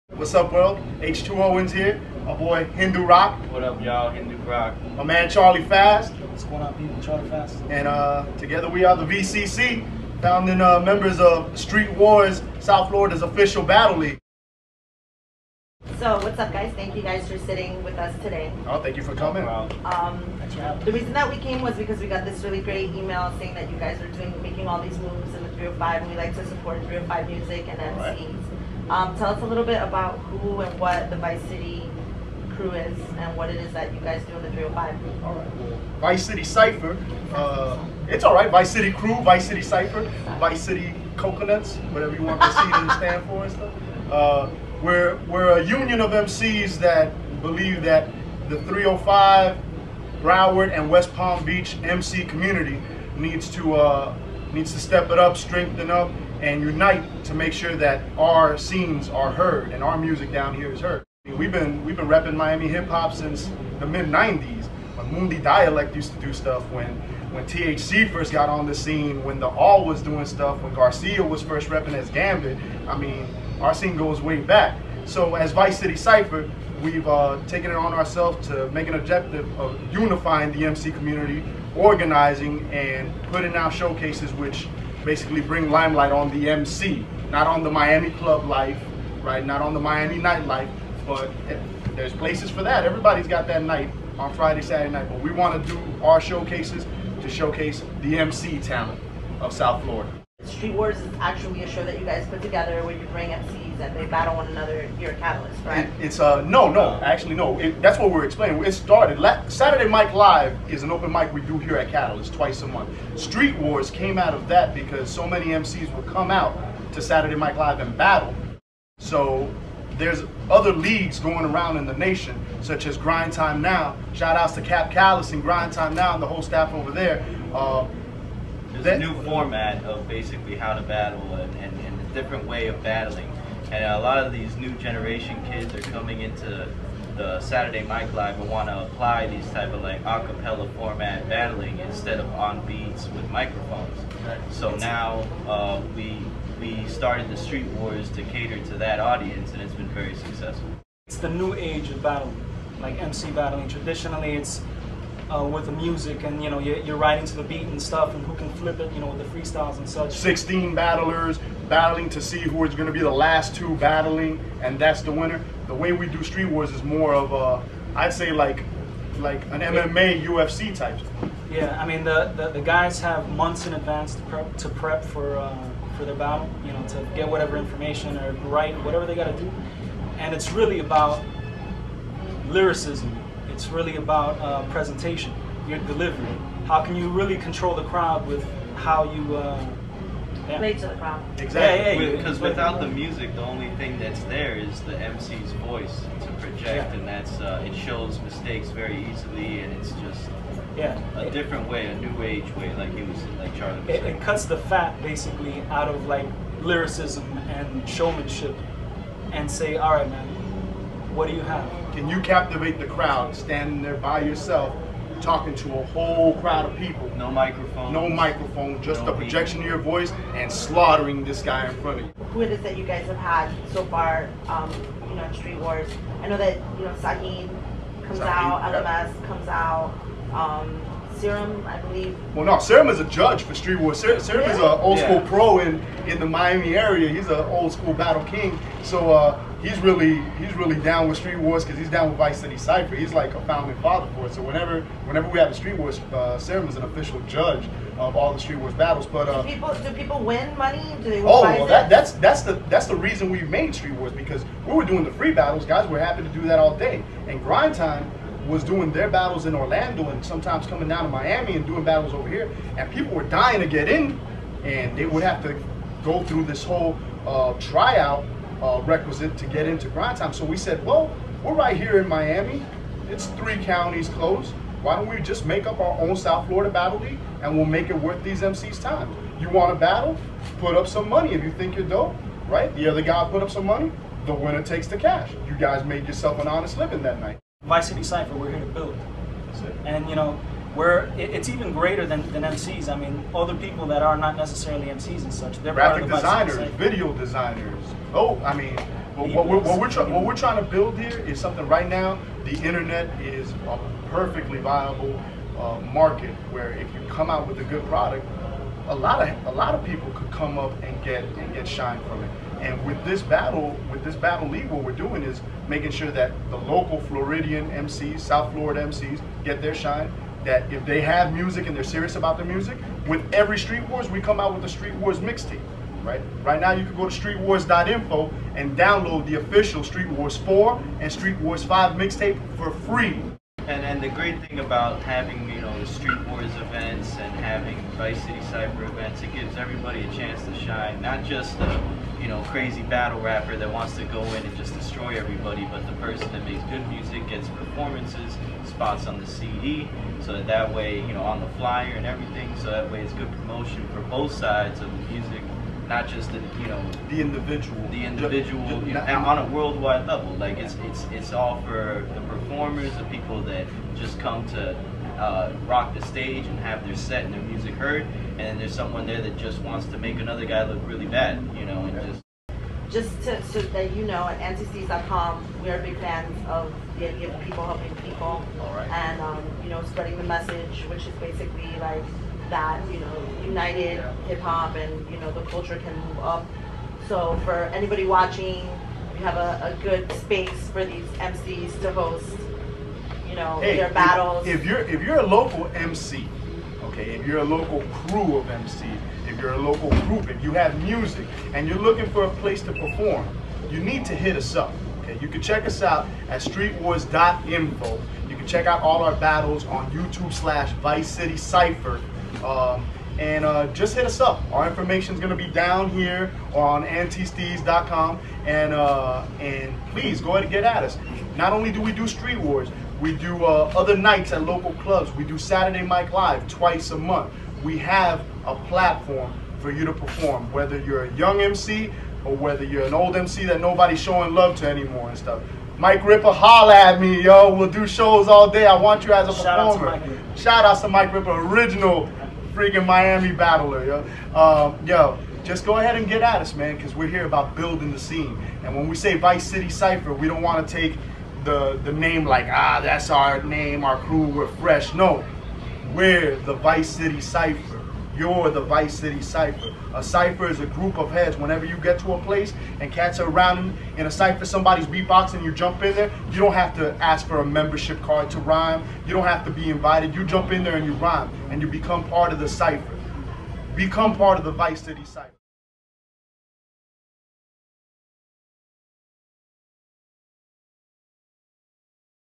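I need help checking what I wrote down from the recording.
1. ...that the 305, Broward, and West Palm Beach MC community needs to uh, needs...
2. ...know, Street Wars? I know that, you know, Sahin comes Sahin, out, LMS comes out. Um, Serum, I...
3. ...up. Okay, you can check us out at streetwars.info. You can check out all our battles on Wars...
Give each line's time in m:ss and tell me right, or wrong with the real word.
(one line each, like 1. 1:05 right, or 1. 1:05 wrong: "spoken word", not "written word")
1. 0:47 right
2. 3:45 right
3. 6:44 wrong: "YouTube", not "Wars".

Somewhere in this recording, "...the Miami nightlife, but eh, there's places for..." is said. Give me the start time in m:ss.
1:29.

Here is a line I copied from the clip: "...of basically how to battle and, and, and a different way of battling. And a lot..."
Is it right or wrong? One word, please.
right.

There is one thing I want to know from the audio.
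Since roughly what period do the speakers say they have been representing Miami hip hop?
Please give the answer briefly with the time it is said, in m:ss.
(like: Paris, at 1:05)
mid '90s, at 1:03.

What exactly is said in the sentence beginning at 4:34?
Why don't we just make up our own South Florida Battle League and we'll make it worth these MCs' time?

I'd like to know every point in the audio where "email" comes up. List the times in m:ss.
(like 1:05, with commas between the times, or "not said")
0:22.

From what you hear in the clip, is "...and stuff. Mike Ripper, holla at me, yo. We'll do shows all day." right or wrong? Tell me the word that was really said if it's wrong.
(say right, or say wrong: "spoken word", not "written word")
right.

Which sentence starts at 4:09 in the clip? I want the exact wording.
But uh, do people do people win money?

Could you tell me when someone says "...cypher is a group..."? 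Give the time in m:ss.
7:40.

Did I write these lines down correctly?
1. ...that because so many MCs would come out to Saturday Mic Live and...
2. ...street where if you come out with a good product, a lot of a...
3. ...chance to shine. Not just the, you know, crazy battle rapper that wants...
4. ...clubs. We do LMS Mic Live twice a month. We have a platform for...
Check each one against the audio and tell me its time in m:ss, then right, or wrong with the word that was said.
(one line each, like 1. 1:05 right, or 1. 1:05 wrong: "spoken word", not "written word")
1. 1:54 right
2. 5:05 wrong: "market", not "street"
3. 5:40 right
4. 7:04 wrong: "Saturday", not "LMS".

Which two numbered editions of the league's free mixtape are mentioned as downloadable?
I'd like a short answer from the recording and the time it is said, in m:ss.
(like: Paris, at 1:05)
Street Wars 4 and 5, at 5:29.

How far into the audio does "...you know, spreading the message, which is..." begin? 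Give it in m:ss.
6:19.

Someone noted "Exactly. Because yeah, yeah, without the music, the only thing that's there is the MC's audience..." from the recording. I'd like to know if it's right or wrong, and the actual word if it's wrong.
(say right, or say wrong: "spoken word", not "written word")
wrong: "voice", not "audience".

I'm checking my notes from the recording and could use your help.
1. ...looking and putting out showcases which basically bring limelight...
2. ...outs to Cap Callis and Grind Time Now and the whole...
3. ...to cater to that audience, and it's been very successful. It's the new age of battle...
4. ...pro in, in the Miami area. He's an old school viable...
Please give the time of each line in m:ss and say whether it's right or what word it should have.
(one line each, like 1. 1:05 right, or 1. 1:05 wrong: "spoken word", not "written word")
1. 1:21 wrong: "organizing", not "looking"
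2. 2:04 right
3. 2:28 right
4. 3:55 wrong: "battle", not "viable".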